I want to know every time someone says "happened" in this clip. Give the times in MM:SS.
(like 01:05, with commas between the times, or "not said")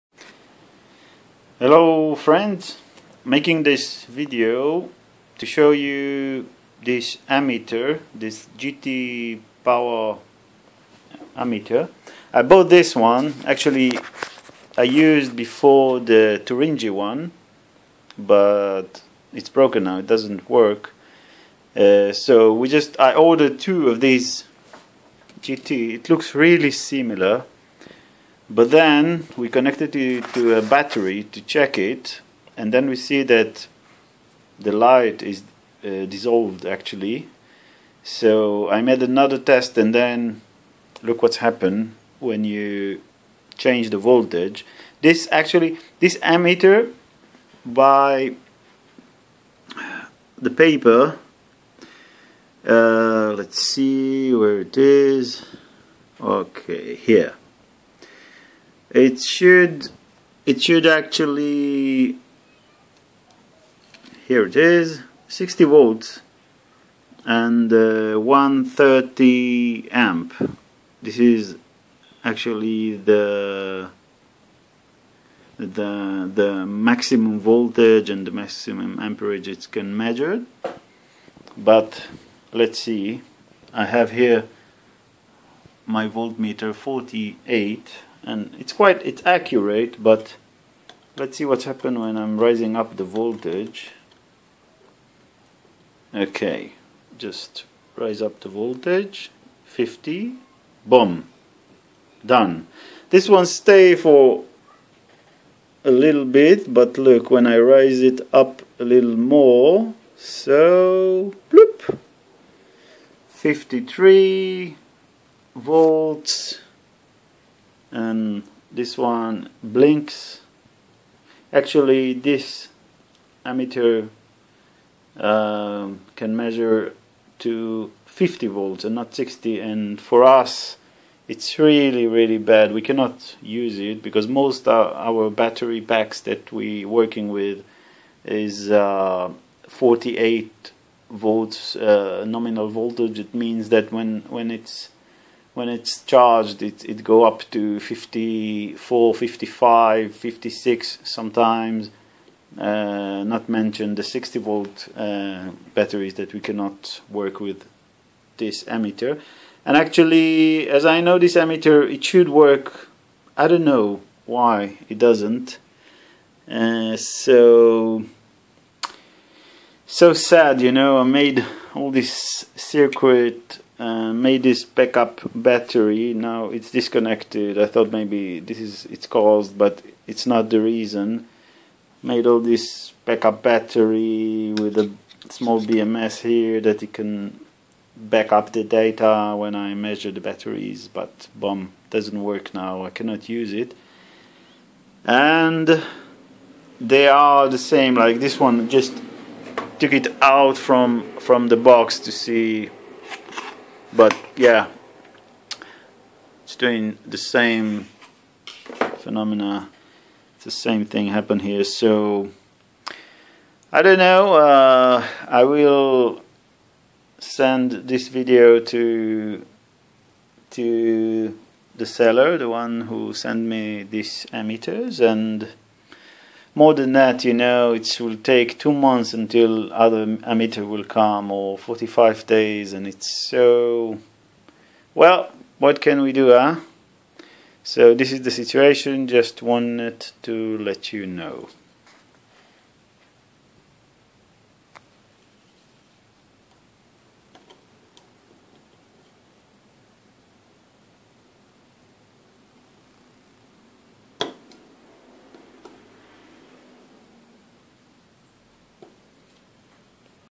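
00:41, 01:31, 03:31.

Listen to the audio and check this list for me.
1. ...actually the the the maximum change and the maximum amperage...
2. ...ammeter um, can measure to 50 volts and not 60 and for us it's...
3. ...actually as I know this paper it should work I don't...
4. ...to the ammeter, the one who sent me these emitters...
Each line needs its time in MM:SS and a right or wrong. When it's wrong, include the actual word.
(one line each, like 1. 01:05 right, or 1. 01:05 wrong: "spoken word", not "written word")
1. 01:12 wrong: "voltage", not "change"
2. 02:03 right
3. 02:39 wrong: "emitter", not "paper"
4. 03:40 wrong: "seller", not "ammeter".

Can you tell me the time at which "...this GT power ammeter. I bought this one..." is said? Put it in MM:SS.
00:08.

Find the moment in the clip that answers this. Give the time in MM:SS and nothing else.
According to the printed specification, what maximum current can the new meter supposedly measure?
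01:08.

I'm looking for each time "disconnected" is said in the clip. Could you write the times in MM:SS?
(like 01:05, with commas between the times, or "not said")
02:56.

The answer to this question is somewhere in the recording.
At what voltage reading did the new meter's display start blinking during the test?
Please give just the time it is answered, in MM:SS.
01:53.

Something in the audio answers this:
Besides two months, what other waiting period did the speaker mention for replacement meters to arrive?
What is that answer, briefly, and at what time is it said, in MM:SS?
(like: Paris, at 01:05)
45 days, at 03:51.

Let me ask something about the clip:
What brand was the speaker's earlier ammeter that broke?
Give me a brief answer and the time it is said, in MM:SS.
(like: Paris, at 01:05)
Turnigy, at 00:16.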